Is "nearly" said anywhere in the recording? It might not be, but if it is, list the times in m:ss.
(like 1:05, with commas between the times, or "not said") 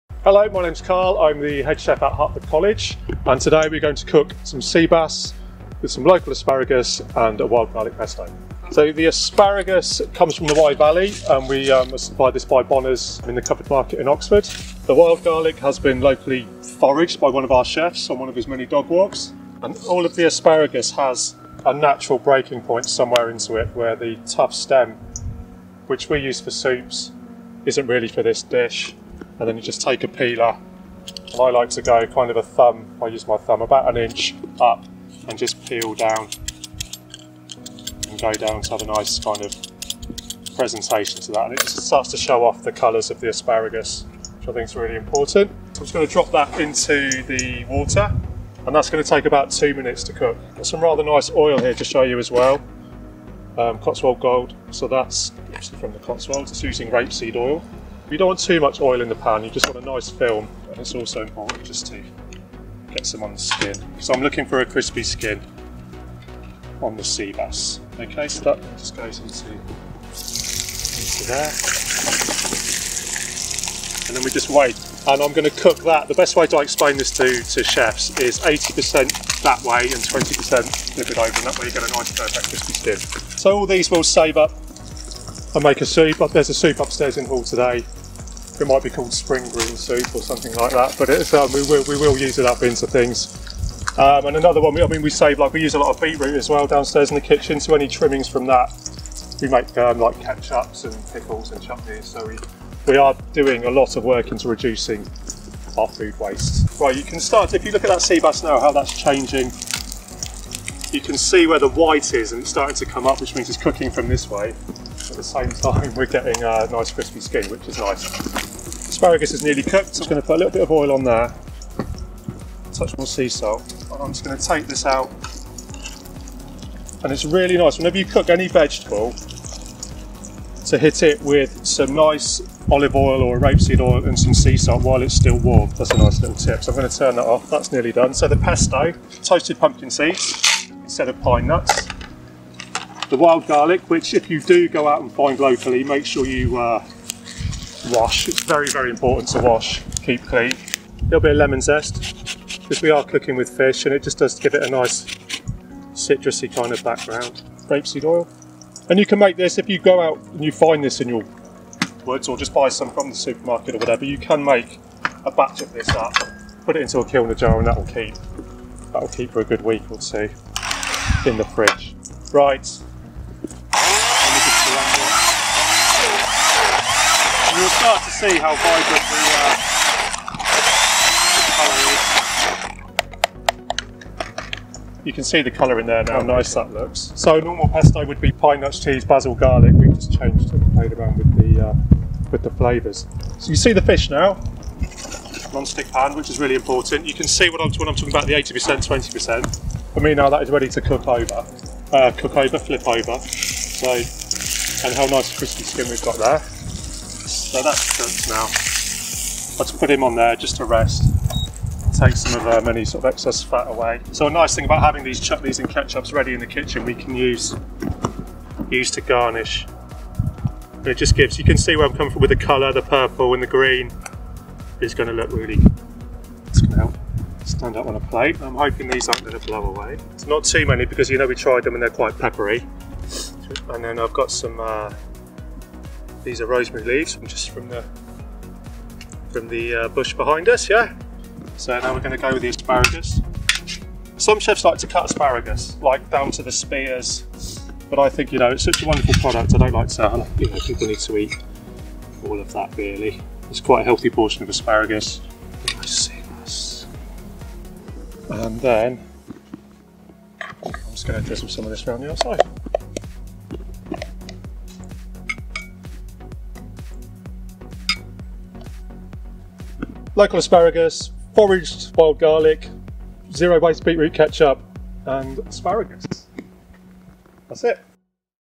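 1:59, 2:17.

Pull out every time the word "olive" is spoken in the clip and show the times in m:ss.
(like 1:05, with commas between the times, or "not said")
2:12.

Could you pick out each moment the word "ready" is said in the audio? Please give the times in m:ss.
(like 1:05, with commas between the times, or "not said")
3:20, 3:36.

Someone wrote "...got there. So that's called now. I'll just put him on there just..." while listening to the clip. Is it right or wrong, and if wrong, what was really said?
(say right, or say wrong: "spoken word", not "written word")
wrong: "cooked", not "called".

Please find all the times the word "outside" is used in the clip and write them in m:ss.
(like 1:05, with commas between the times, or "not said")
4:22.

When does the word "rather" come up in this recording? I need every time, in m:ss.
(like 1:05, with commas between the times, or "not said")
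0:50.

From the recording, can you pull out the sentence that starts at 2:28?
It's very, very important to wash, keep clean.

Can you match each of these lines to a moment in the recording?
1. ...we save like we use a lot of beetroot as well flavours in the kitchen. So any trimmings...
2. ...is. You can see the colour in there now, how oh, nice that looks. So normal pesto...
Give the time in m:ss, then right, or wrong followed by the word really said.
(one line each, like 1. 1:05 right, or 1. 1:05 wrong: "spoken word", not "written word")
1. 1:35 wrong: "downstairs", not "flavours"
2. 3:03 right.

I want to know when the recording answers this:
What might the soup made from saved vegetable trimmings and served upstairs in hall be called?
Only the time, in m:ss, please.
1:29.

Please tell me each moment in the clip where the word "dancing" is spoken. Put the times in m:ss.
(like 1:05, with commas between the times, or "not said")
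not said.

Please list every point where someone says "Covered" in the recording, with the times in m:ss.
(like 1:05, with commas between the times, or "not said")
0:13.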